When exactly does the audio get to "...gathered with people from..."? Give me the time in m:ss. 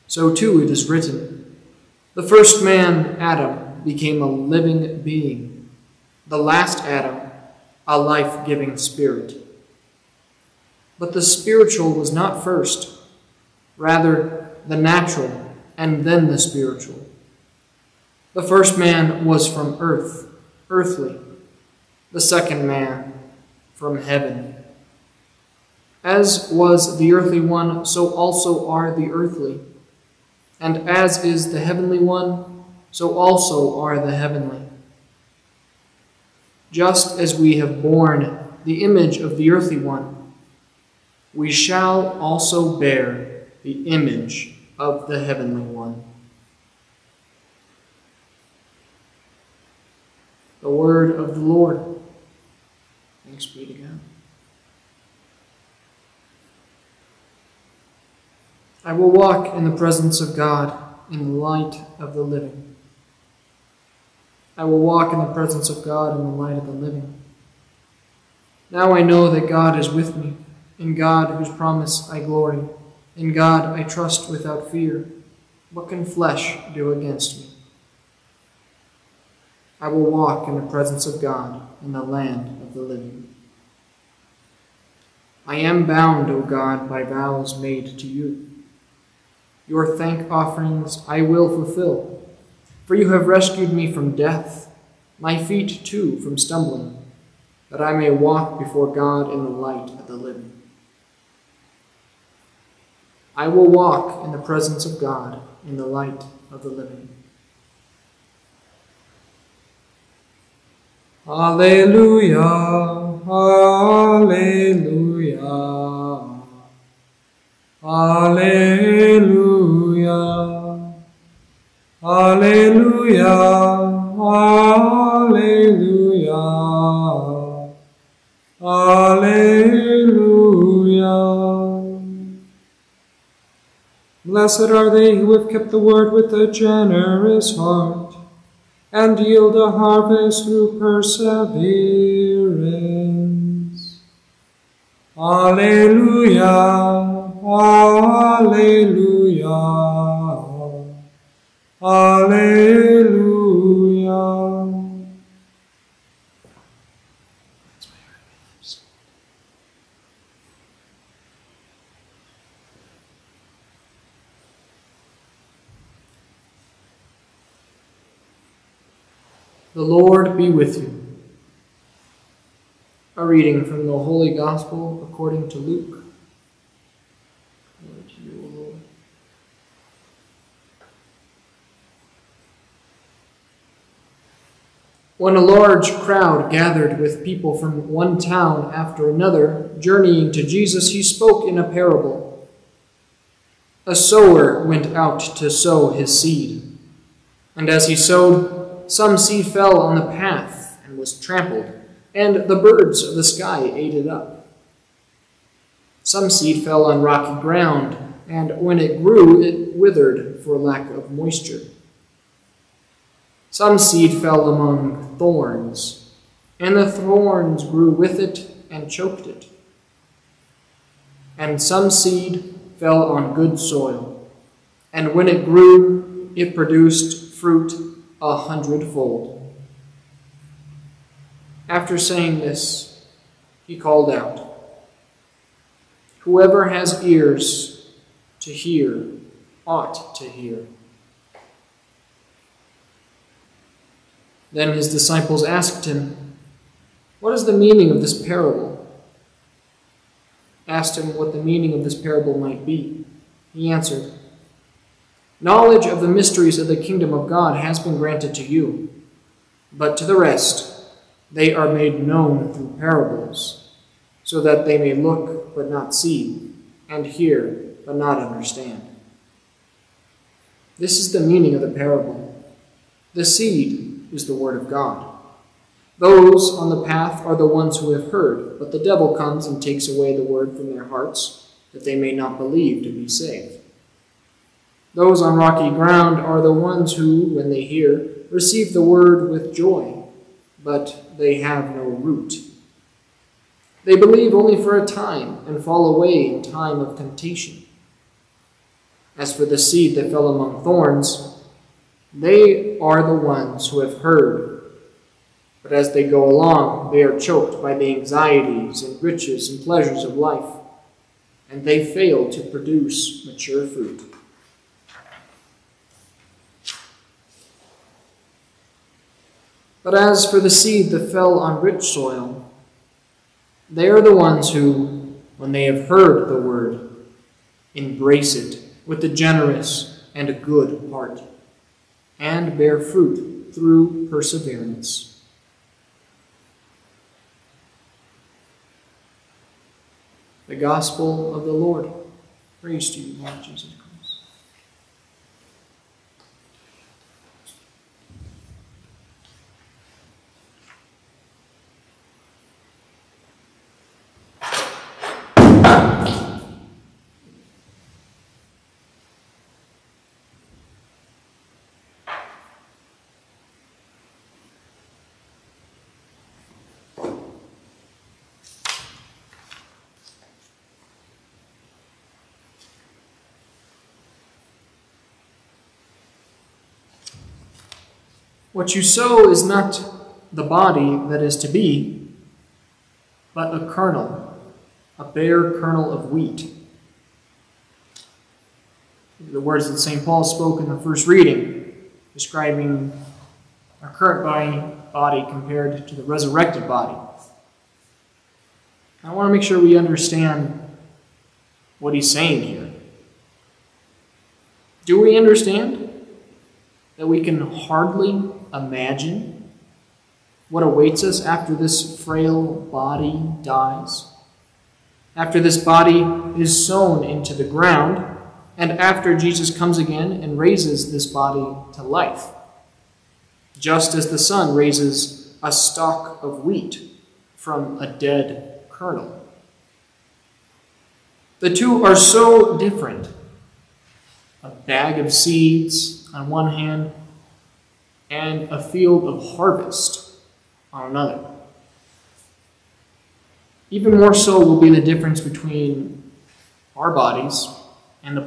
3:06.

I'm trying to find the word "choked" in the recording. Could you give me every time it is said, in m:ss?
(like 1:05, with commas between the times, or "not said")
3:38, 5:07.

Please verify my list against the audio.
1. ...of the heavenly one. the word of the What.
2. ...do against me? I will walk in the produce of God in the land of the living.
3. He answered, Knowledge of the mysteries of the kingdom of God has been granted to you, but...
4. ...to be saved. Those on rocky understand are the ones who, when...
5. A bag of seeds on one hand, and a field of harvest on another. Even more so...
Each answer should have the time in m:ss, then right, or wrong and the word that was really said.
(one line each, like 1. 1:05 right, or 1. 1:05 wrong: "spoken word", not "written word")
1. 0:44 wrong: "Lord", not "What"
2. 1:16 wrong: "presence", not "produce"
3. 4:13 right
4. 4:42 wrong: "ground", not "understand"
5. 7:14 right.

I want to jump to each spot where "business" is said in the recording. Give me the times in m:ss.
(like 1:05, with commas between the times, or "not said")
not said.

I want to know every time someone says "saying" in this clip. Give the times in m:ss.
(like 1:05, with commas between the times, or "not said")
3:51, 6:42.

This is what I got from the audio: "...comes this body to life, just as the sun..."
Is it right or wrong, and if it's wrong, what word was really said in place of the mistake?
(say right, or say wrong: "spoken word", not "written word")
wrong: "raises", not "comes".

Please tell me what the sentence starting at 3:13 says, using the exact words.
A sower went out to sow his seed.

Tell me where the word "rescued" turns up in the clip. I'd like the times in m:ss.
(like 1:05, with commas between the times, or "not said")
1:33.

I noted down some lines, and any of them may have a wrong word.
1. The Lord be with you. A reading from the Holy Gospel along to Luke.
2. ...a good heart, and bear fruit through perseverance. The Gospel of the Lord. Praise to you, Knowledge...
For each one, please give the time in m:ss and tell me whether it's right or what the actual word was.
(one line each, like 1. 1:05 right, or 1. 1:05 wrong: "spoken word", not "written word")
1. 2:49 wrong: "according", not "along"
2. 5:30 wrong: "Lord", not "Knowledge".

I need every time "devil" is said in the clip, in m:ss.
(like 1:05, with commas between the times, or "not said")
4:38.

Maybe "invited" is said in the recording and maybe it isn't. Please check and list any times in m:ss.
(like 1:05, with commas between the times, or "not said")
not said.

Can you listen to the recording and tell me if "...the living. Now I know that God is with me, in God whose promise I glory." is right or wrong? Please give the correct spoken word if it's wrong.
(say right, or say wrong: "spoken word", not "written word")
right.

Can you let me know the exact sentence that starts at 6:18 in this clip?
What you sow is not the body that is to be, but a kernel, a bare kernel of wheat.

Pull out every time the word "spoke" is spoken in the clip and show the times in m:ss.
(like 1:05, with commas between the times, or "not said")
3:11, 6:30.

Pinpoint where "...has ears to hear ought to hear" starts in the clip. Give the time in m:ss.
3:56.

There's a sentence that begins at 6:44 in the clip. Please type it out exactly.
Do we understand that we can hardly imagine what awaits us after this frail body dies?